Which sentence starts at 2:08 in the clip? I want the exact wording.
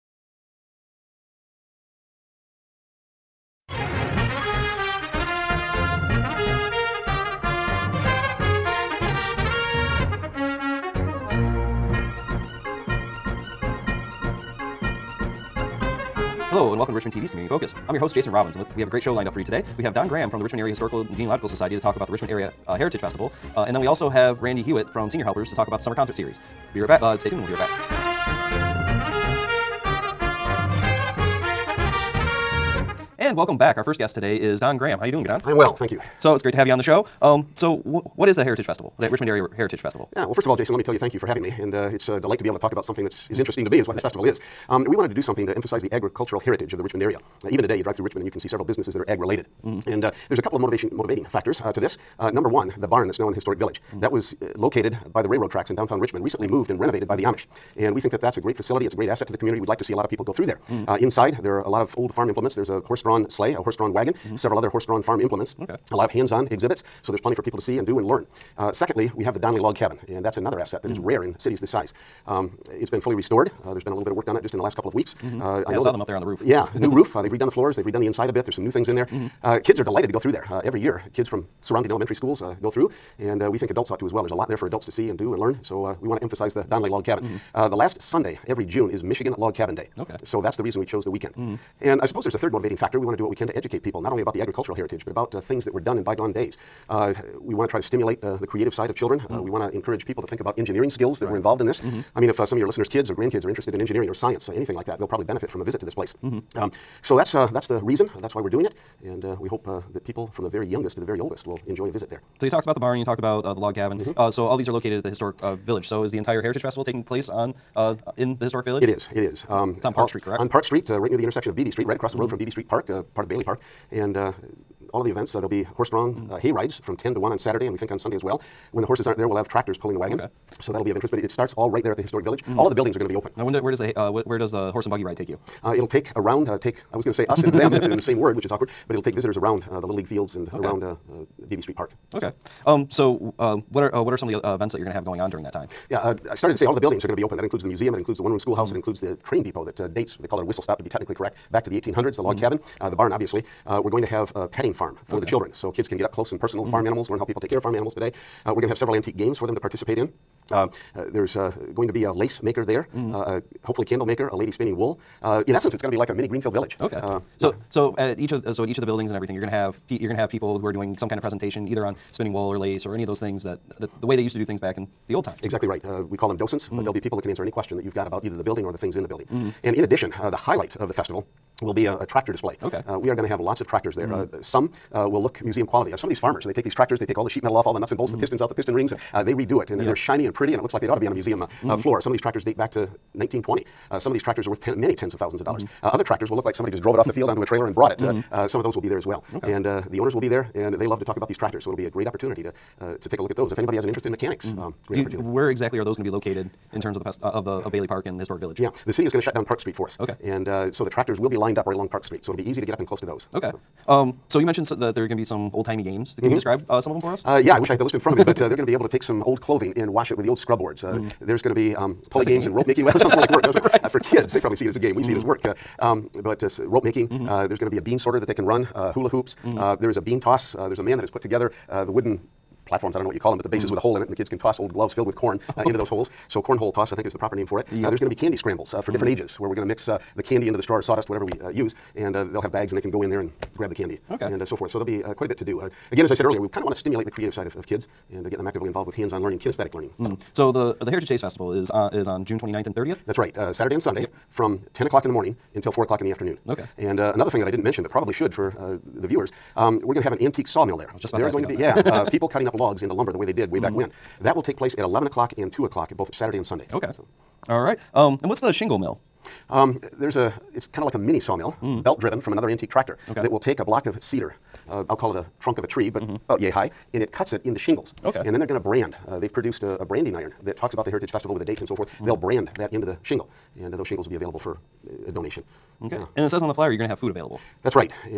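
When the horses aren't there, we'll have tractors pulling the wagon.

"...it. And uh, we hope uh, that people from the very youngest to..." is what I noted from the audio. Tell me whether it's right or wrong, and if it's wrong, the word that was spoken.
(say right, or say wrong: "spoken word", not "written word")
right.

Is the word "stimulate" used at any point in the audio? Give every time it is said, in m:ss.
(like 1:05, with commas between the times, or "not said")
1:37, 4:06.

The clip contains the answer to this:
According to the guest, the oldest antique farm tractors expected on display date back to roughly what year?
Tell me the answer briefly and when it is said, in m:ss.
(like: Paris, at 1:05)
1920, at 3:13.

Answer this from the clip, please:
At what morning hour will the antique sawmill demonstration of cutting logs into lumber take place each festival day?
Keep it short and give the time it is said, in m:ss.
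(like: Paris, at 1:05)
11 o'clock, at 4:24.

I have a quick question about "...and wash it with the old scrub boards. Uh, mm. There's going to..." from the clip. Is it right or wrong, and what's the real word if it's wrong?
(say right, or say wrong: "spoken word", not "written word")
right.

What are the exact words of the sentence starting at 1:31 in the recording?
And I suppose there's a third motivating factor.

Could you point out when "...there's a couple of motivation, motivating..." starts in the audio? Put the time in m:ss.
0:50.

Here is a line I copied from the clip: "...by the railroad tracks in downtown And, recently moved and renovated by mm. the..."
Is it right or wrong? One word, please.
wrong.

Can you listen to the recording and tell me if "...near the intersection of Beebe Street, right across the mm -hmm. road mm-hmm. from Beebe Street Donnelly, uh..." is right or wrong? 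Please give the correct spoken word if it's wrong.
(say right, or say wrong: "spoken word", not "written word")
wrong: "Park", not "Donnelly".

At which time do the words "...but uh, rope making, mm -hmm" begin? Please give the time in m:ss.
3:46.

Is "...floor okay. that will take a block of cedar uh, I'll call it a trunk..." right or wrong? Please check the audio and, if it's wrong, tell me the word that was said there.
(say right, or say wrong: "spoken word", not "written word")
wrong: "tractor", not "floor".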